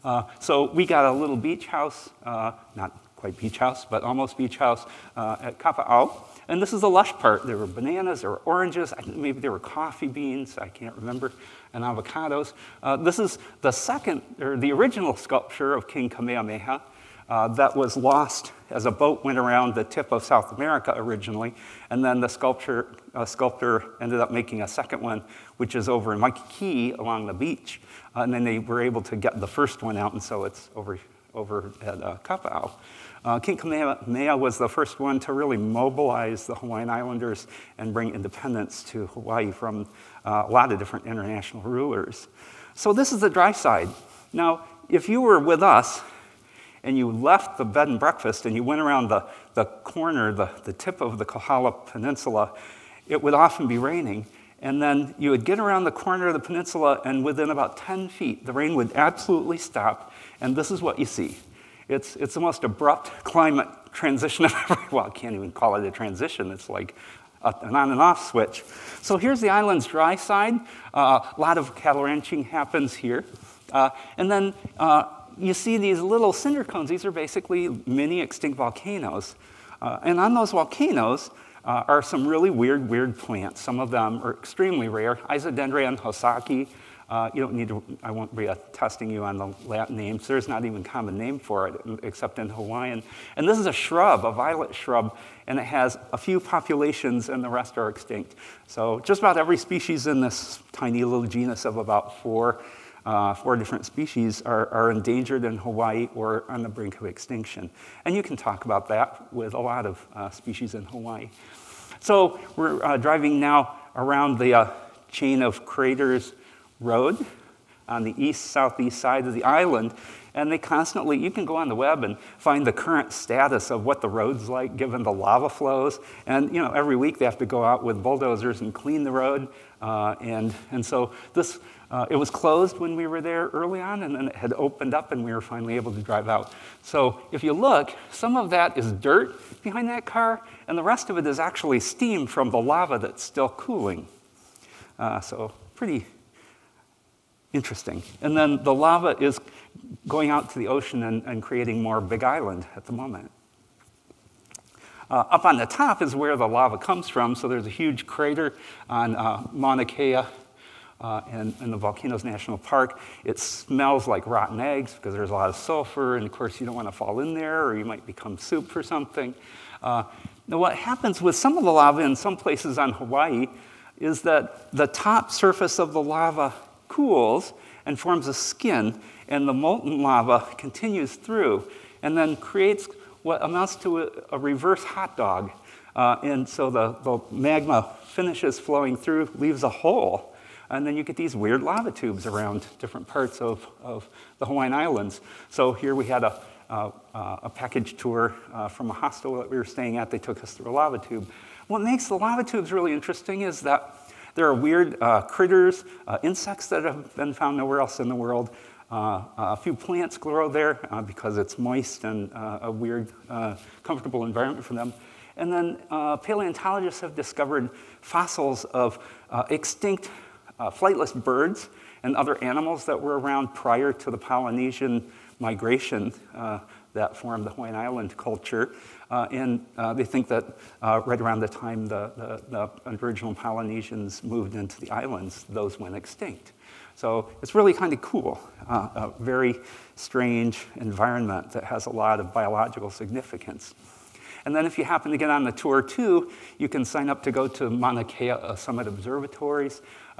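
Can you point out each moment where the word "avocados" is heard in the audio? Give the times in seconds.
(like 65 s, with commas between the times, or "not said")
11 s.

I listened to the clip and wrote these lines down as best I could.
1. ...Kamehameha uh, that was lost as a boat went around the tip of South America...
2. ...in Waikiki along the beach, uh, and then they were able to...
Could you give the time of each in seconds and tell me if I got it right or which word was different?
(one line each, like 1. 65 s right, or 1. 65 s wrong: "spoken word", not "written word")
1. 16 s right
2. 26 s right.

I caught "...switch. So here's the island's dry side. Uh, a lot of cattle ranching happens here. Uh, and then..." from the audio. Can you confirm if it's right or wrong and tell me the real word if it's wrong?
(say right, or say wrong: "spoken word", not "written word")
right.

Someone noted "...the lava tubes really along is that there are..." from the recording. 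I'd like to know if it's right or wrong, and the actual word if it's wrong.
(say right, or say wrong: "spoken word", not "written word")
wrong: "interesting", not "along".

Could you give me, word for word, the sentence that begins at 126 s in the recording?
And you know, every week they have to go out with bulldozers and clean the road.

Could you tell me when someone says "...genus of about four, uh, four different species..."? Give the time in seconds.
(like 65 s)
101 s.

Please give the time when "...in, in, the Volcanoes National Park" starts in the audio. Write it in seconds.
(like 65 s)
161 s.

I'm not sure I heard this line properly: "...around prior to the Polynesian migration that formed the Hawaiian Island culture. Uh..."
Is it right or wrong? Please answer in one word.
right.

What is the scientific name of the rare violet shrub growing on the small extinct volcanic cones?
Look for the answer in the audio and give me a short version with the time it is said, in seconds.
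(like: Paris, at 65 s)
Isodendrion hosakae, at 85 s.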